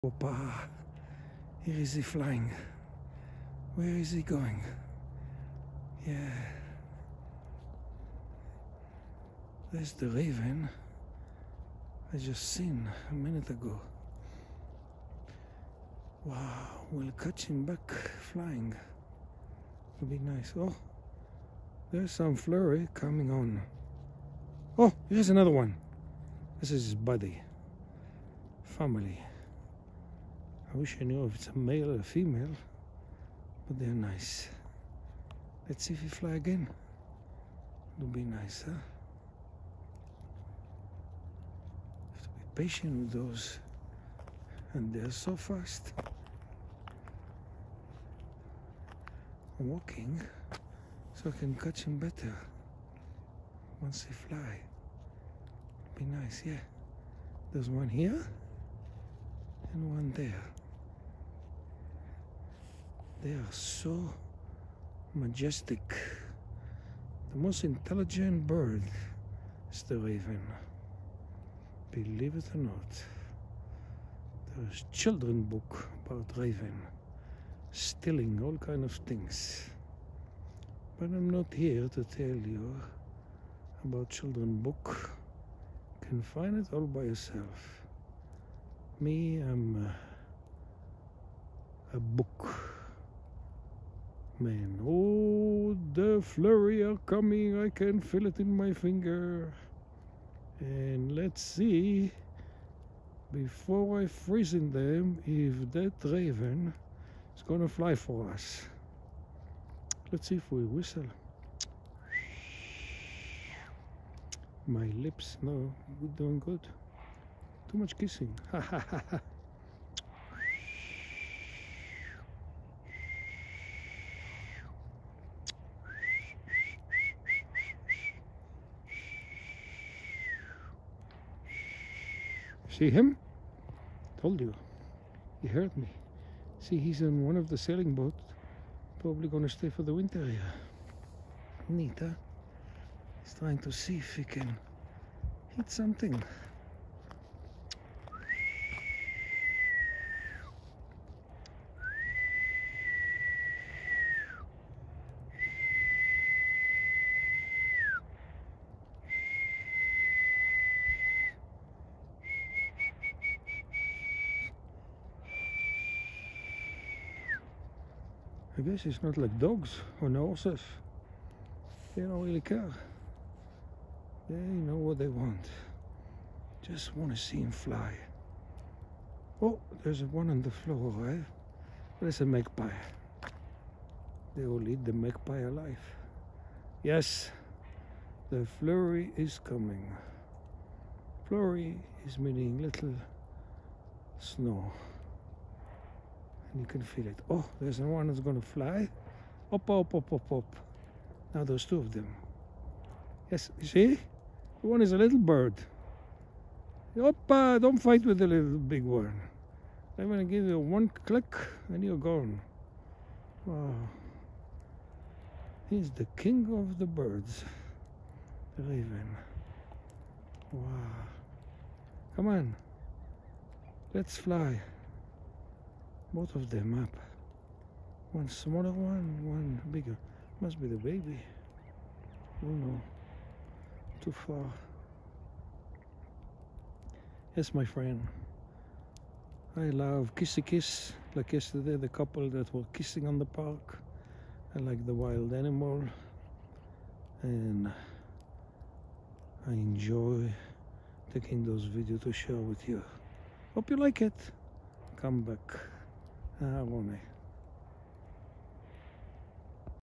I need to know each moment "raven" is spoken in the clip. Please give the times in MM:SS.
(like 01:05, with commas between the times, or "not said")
00:10, 01:09, 01:16, 01:46, 03:38.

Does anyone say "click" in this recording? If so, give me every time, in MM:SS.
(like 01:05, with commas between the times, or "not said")
03:31.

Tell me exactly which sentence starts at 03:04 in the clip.
They will eat the magpie alive.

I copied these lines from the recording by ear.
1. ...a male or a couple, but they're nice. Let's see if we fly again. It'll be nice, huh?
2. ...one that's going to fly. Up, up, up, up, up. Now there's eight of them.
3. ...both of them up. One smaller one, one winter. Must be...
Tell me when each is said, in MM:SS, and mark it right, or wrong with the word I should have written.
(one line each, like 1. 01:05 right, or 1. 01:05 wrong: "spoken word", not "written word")
1. 00:31 wrong: "female", not "couple"
2. 03:17 wrong: "two", not "eight"
3. 03:46 wrong: "bigger", not "winter".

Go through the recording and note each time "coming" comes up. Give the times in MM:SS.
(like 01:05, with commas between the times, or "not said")
00:22, 01:37, 03:09.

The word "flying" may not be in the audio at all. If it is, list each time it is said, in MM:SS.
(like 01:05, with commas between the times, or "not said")
00:02, 00:18.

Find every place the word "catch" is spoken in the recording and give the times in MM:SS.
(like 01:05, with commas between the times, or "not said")
00:17, 00:51.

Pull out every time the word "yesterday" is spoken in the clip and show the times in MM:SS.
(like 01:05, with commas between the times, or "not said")
04:01.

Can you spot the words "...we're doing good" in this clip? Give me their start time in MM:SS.
01:56.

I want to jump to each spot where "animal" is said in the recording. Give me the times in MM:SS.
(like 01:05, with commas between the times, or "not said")
04:05.